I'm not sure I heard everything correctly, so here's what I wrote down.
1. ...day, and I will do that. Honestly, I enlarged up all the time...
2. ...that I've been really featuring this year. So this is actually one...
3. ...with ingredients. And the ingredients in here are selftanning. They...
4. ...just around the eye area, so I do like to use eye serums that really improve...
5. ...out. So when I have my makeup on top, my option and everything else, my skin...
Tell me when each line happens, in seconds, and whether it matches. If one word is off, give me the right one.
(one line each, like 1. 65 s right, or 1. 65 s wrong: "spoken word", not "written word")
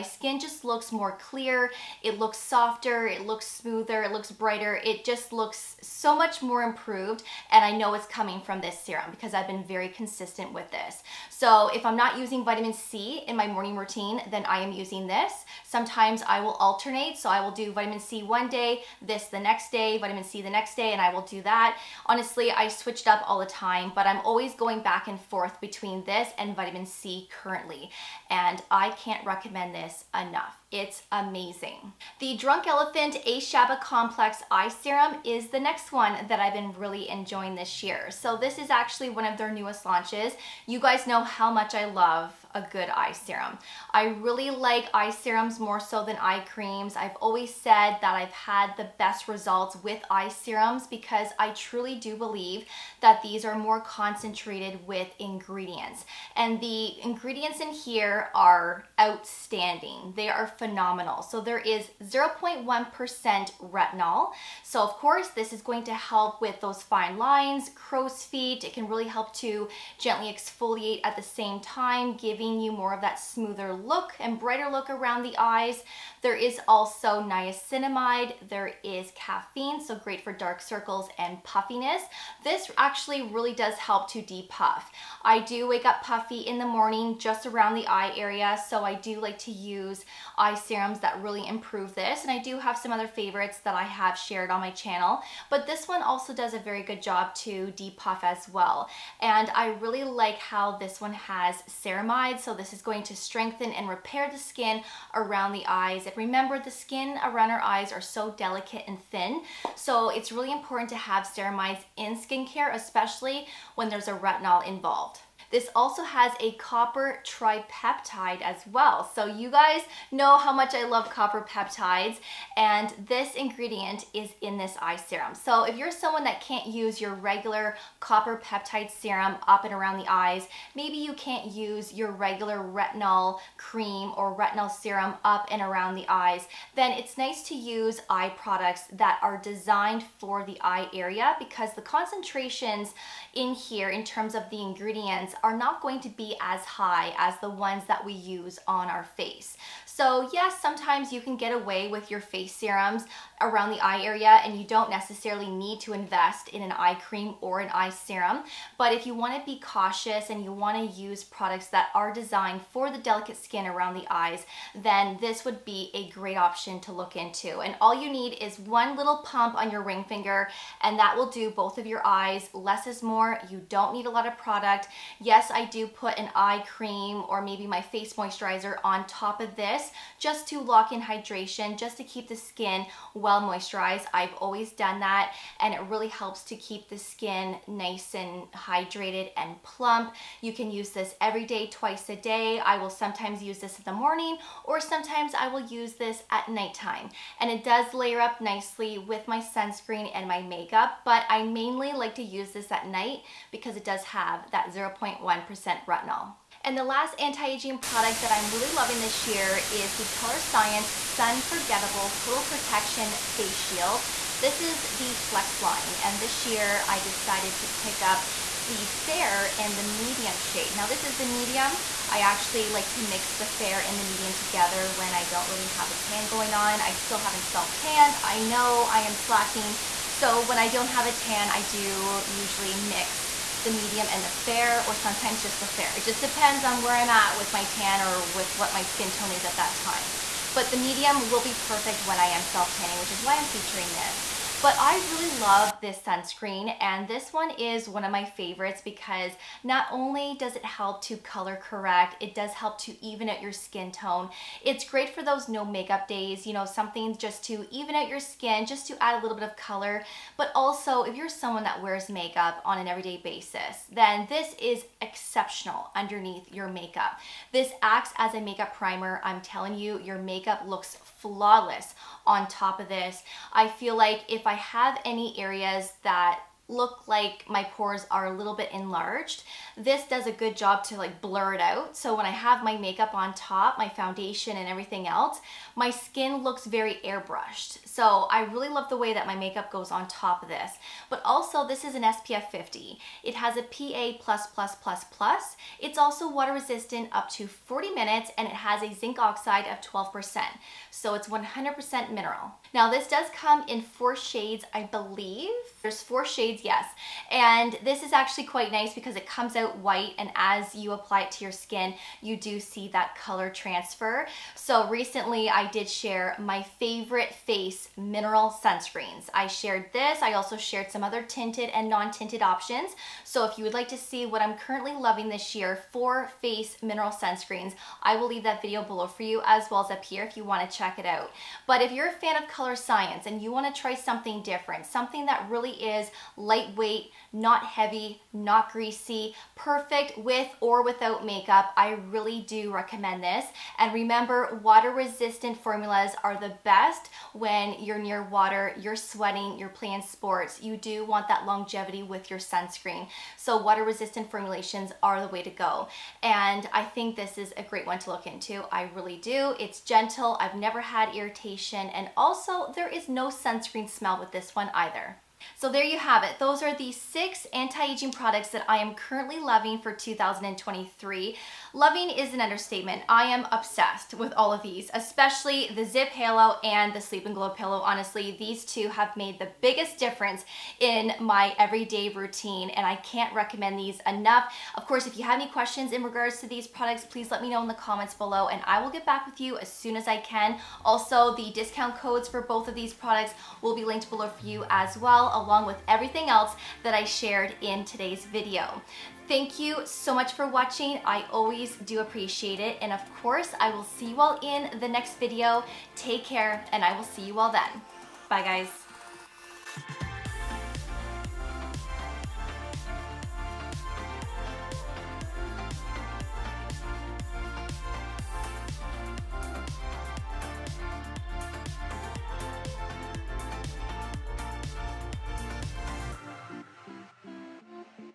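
1. 20 s wrong: "switched", not "enlarged"
2. 36 s wrong: "enjoying", not "featuring"
3. 54 s wrong: "outstanding", not "selftanning"
4. 87 s right
5. 281 s wrong: "foundation", not "option".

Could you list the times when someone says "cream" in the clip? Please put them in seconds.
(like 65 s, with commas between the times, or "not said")
46 s, 133 s, 156 s, 176 s.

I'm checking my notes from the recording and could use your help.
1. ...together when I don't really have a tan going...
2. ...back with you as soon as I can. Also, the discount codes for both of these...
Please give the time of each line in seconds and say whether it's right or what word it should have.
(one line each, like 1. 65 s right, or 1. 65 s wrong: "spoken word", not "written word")
1. 224 s right
2. 389 s right.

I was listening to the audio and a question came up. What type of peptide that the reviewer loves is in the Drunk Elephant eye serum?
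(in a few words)
copper tripeptide.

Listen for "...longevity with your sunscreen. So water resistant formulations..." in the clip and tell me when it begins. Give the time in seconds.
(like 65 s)
351 s.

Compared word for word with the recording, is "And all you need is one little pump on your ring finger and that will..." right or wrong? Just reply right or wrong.
right.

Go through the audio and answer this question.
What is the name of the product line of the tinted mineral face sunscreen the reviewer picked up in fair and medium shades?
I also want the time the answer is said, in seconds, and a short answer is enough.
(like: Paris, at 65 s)
Flex, at 215 s.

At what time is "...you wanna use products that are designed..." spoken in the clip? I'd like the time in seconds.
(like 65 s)
160 s.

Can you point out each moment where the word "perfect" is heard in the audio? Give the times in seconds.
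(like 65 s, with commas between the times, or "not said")
241 s, 339 s.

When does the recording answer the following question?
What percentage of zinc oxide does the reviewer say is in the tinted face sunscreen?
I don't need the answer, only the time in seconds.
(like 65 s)
299 s.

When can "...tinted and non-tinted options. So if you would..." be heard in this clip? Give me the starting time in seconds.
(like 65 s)
321 s.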